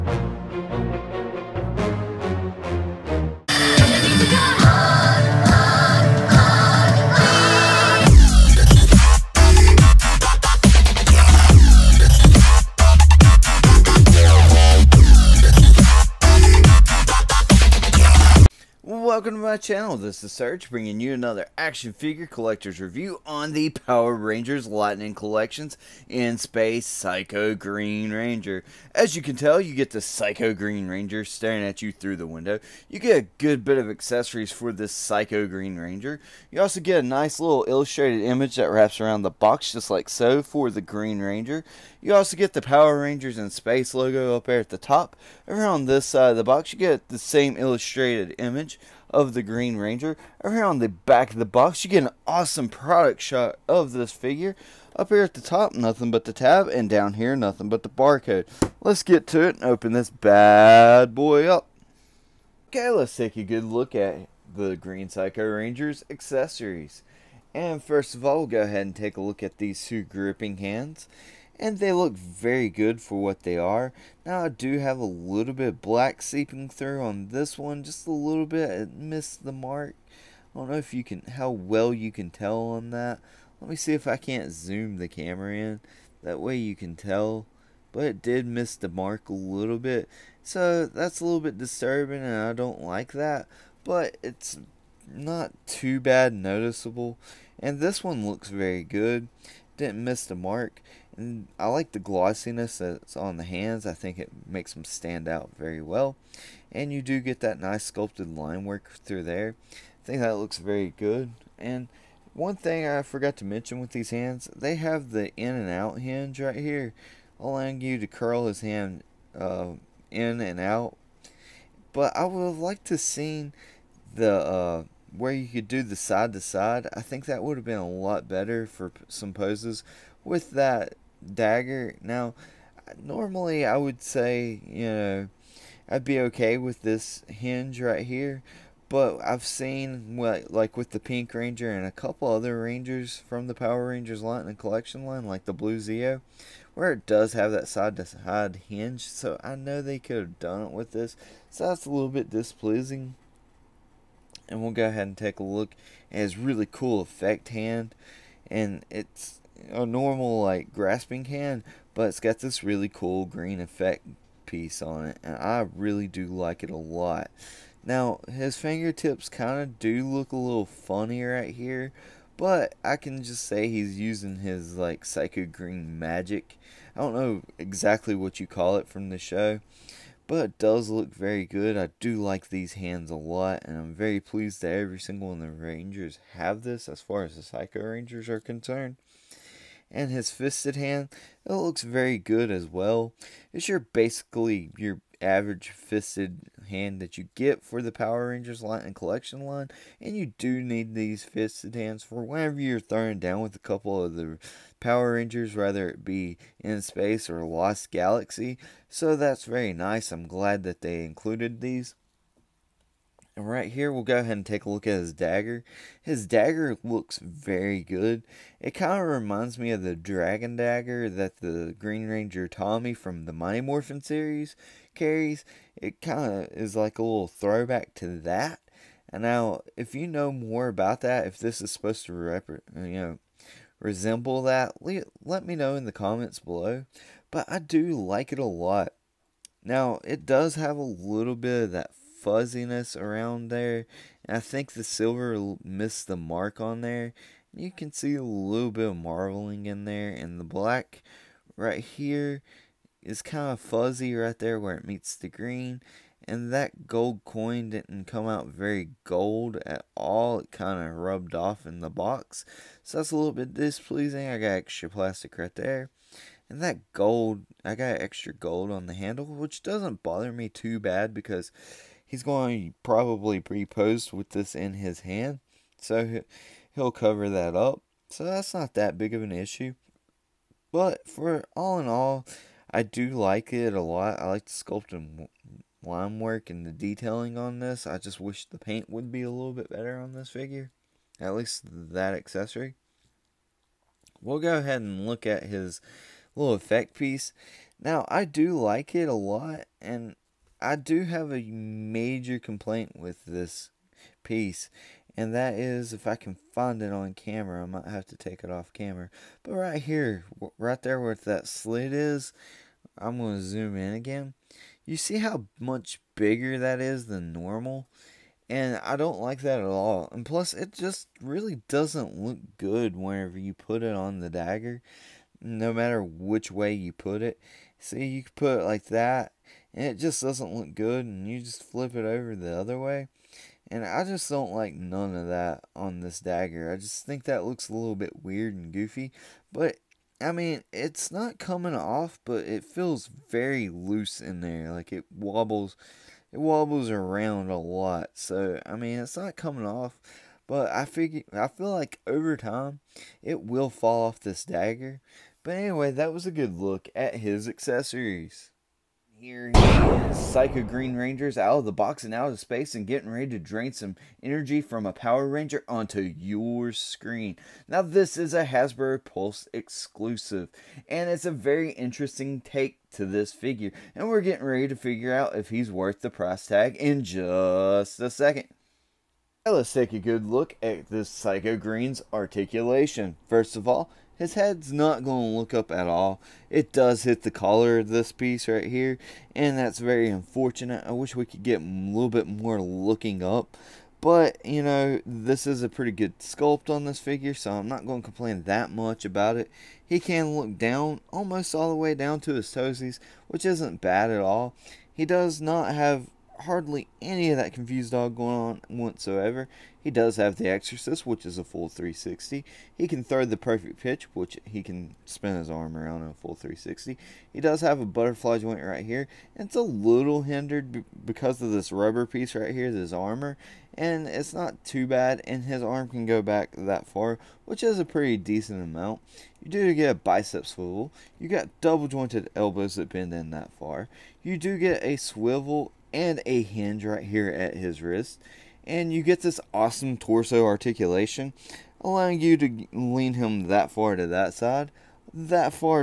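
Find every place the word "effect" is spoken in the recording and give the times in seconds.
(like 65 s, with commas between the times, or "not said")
157 s, 163 s, 296 s.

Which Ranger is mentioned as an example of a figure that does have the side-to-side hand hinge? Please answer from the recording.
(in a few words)
Blue Zeo.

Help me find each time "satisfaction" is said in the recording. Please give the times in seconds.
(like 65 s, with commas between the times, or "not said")
not said.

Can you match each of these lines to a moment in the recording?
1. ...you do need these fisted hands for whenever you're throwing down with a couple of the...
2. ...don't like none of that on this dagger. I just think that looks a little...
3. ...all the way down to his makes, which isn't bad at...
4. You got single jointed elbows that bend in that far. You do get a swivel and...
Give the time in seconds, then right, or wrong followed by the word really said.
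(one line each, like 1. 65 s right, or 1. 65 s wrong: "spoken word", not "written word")
1. 200 s right
2. 334 s right
3. 401 s wrong: "toesies", not "makes"
4. 431 s wrong: "double", not "single".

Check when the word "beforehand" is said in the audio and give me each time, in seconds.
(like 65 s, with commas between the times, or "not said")
not said.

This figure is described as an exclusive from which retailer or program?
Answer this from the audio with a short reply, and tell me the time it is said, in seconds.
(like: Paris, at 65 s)
Hasbro Pulse, at 368 s.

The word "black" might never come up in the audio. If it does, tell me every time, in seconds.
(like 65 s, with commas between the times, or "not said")
75 s, 250 s.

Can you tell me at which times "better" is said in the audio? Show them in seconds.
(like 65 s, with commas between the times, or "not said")
128 s, 289 s.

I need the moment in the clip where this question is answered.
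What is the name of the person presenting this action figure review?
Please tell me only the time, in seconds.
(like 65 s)
20 s.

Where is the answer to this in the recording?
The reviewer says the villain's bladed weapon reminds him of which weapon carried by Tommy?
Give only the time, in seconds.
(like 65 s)
219 s.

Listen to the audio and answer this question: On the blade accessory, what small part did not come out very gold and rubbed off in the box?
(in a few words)
coin.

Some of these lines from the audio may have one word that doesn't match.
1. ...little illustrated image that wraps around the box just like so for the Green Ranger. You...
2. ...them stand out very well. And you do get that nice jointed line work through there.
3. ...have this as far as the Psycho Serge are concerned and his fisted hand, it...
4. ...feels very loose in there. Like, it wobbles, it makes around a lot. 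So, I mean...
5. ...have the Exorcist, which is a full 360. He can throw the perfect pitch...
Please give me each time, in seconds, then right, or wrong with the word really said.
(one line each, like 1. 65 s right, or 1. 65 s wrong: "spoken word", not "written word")
1. 37 s right
2. 104 s wrong: "sculpted", not "jointed"
3. 186 s wrong: "Rangers", not "Serge"
4. 342 s wrong: "wobbles", not "makes"
5. 410 s right.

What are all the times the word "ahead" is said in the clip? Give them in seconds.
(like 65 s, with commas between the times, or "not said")
68 s, 154 s, 214 s, 294 s.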